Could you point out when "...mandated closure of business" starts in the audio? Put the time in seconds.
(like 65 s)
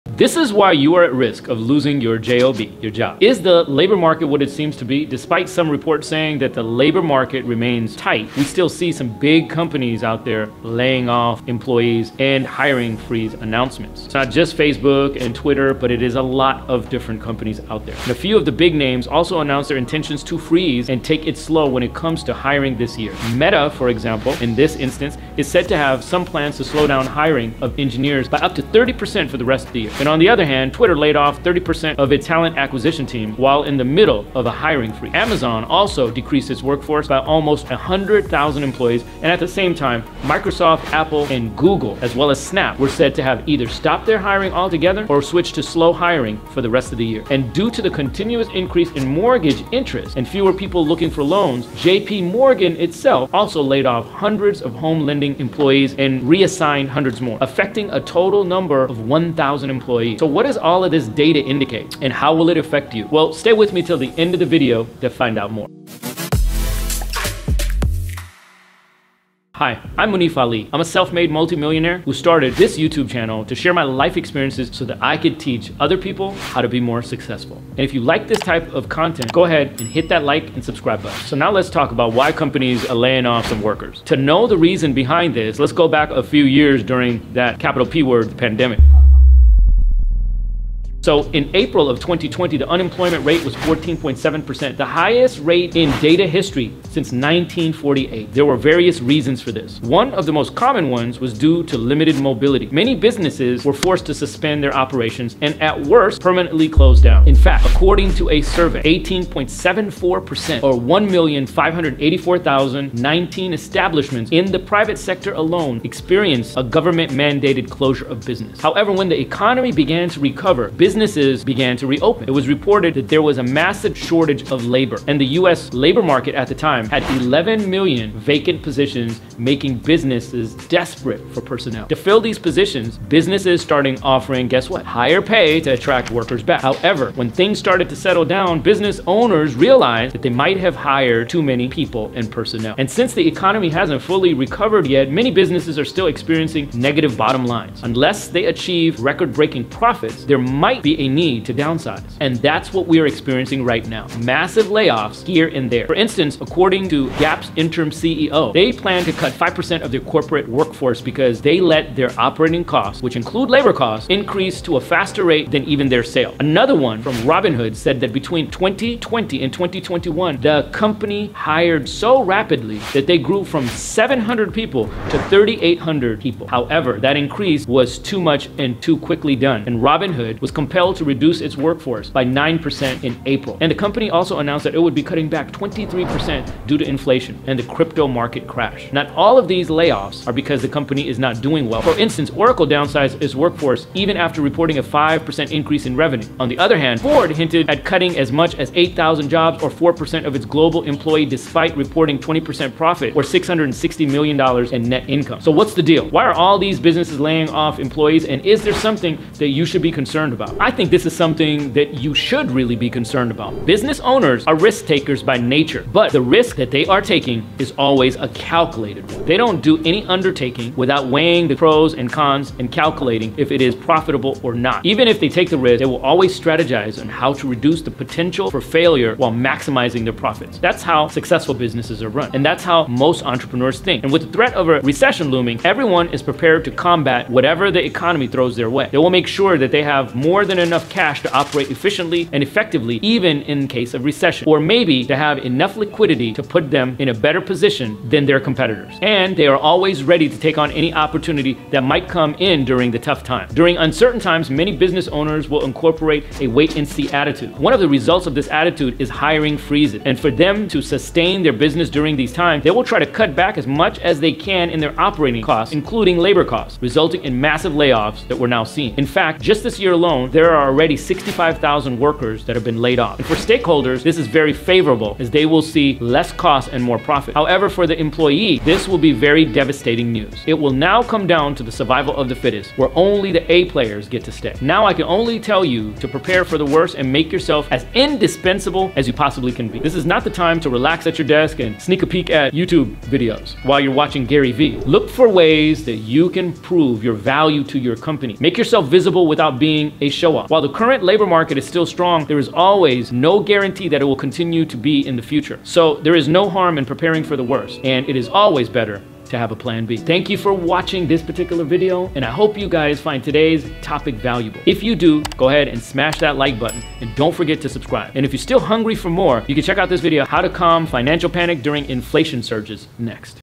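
117 s.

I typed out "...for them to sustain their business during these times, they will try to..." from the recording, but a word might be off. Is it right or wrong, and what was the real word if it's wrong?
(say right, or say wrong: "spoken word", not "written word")
right.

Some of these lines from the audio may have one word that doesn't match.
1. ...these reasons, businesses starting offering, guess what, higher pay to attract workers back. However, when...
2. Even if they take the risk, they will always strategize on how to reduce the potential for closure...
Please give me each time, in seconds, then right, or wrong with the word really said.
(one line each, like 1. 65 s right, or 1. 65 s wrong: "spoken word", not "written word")
1. 132 s wrong: "positions", not "reasons"
2. 224 s wrong: "failure", not "closure".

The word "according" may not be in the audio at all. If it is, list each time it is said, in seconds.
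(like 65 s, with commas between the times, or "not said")
107 s, 156 s.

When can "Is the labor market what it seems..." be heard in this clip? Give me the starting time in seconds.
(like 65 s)
3 s.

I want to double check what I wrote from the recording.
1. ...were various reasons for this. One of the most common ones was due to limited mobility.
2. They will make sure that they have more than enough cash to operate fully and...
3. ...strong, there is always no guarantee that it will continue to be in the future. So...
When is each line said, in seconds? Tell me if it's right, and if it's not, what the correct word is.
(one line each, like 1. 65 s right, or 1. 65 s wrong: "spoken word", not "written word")
1. 98 s right
2. 238 s wrong: "efficiently", not "fully"
3. 301 s right.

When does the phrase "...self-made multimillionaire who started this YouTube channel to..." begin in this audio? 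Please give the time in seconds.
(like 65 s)
70 s.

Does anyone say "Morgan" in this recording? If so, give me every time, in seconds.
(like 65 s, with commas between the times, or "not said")
52 s.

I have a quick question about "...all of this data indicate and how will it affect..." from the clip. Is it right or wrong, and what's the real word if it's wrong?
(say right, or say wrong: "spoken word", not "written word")
right.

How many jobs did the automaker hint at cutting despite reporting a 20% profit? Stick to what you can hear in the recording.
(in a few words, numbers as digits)
8,000.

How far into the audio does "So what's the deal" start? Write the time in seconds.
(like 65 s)
205 s.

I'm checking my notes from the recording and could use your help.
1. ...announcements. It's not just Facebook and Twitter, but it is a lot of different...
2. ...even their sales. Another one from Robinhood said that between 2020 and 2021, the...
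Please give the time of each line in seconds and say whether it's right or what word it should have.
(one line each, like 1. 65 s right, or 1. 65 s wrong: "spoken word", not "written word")
1. 13 s right
2. 165 s right.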